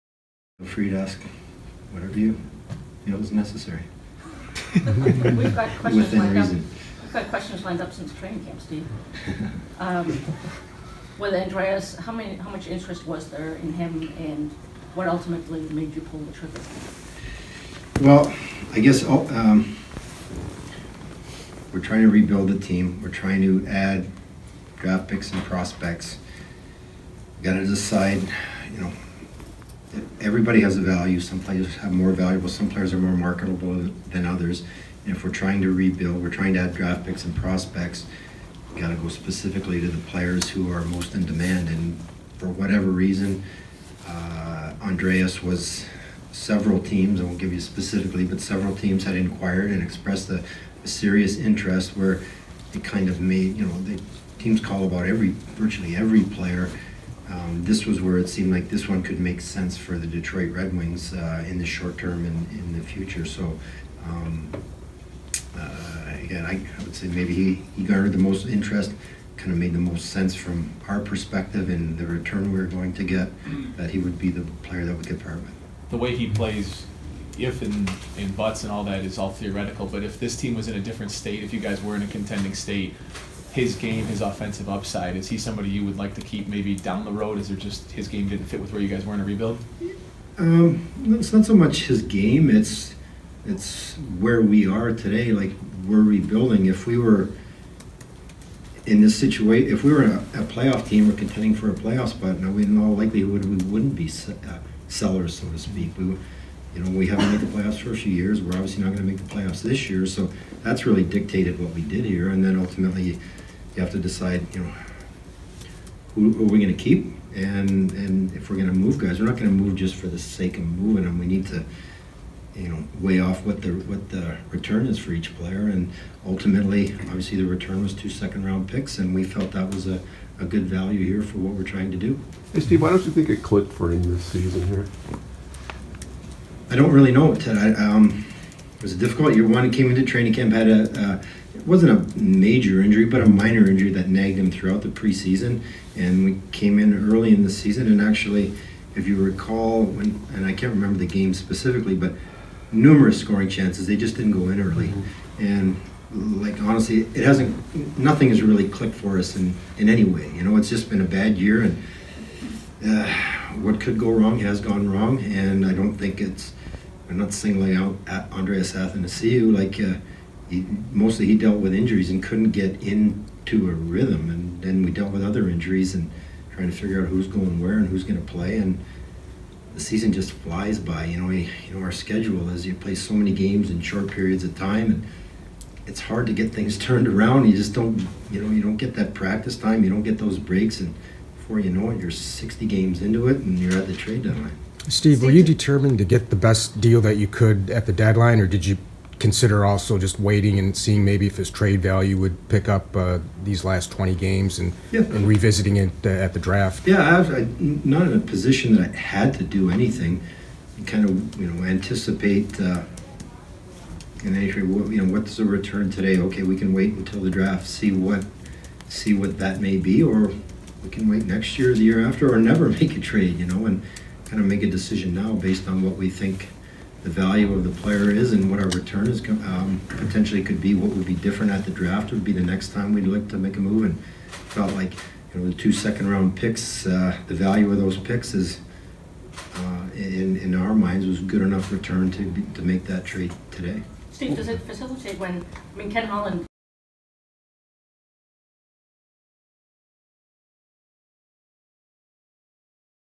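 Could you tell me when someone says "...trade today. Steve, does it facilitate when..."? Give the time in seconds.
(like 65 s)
243 s.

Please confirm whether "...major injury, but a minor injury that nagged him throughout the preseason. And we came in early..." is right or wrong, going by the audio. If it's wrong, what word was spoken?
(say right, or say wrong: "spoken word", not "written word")
right.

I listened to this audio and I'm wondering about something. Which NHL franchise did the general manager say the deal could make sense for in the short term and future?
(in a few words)
Detroit Red Wings.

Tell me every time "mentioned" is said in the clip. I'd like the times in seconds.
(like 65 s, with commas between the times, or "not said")
not said.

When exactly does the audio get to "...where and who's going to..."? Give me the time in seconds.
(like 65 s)
177 s.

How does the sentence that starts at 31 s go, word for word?
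Some players have more valuable, some players are more marketable than others.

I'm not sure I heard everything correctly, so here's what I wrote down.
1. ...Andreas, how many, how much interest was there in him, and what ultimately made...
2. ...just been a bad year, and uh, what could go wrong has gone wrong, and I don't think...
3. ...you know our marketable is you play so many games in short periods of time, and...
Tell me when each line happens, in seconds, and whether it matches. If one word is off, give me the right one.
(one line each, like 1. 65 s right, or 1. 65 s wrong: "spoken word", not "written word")
1. 11 s right
2. 160 s right
3. 181 s wrong: "schedule", not "marketable".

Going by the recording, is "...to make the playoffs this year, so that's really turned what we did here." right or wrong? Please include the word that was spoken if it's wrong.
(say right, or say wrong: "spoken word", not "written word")
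wrong: "dictated", not "turned".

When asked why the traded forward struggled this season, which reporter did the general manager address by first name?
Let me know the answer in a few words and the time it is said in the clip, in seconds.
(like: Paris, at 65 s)
Ted, at 137 s.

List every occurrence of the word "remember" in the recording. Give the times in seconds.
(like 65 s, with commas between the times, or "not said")
150 s.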